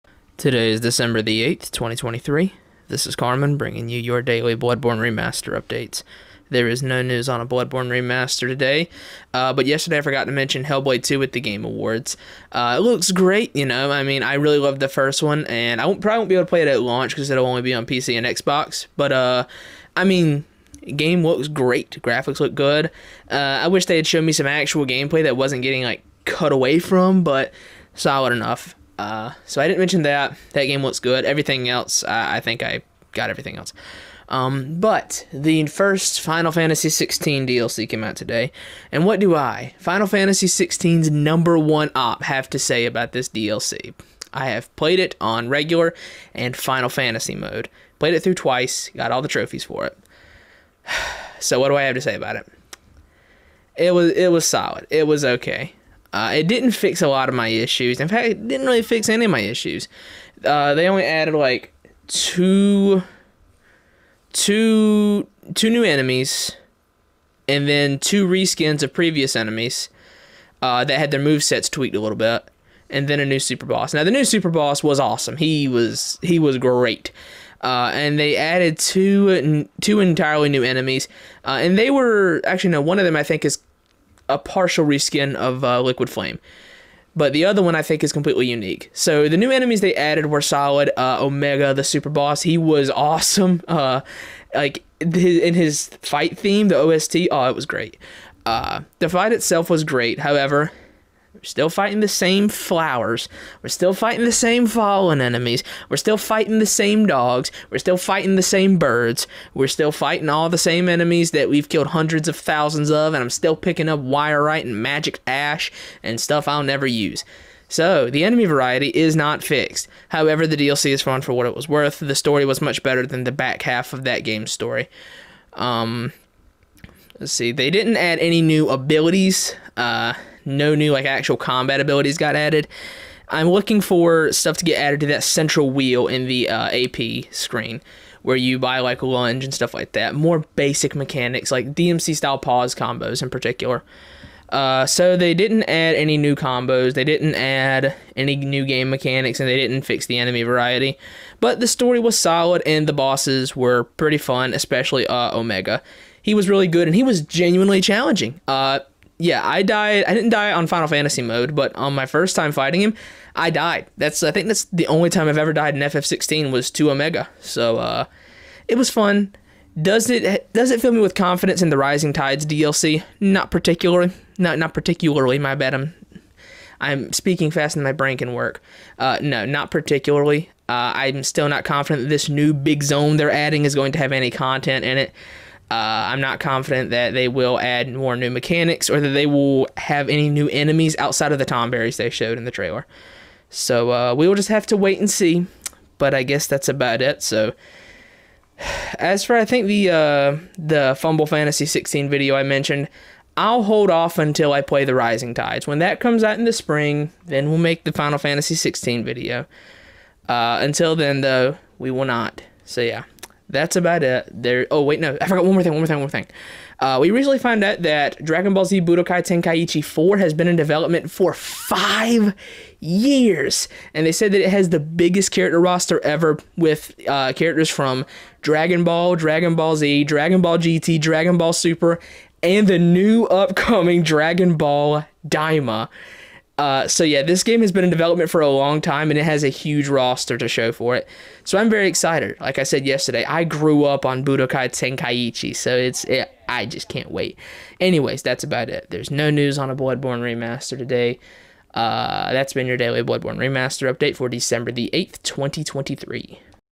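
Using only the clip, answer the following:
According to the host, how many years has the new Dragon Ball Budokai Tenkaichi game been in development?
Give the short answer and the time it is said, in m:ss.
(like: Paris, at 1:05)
5, at 3:41.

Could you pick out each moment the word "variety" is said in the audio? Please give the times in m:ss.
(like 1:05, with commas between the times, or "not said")
1:58, 2:30.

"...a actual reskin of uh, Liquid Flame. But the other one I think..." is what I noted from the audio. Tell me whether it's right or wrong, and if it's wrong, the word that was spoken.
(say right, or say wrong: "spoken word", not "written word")
wrong: "partial", not "actual".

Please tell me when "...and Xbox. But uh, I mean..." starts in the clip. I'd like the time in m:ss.
0:18.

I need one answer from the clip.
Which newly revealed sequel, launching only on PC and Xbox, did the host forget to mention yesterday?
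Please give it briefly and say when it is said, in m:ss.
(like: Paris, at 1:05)
Hellblade 2, at 0:10.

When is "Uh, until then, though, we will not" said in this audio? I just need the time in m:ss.
3:30.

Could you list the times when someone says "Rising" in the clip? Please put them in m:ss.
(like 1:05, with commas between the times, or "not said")
2:51, 3:24.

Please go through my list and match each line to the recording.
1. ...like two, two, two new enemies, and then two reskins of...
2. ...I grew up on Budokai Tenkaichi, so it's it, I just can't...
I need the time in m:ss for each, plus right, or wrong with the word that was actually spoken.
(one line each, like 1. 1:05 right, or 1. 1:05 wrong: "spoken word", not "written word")
1. 1:01 right
2. 4:03 right.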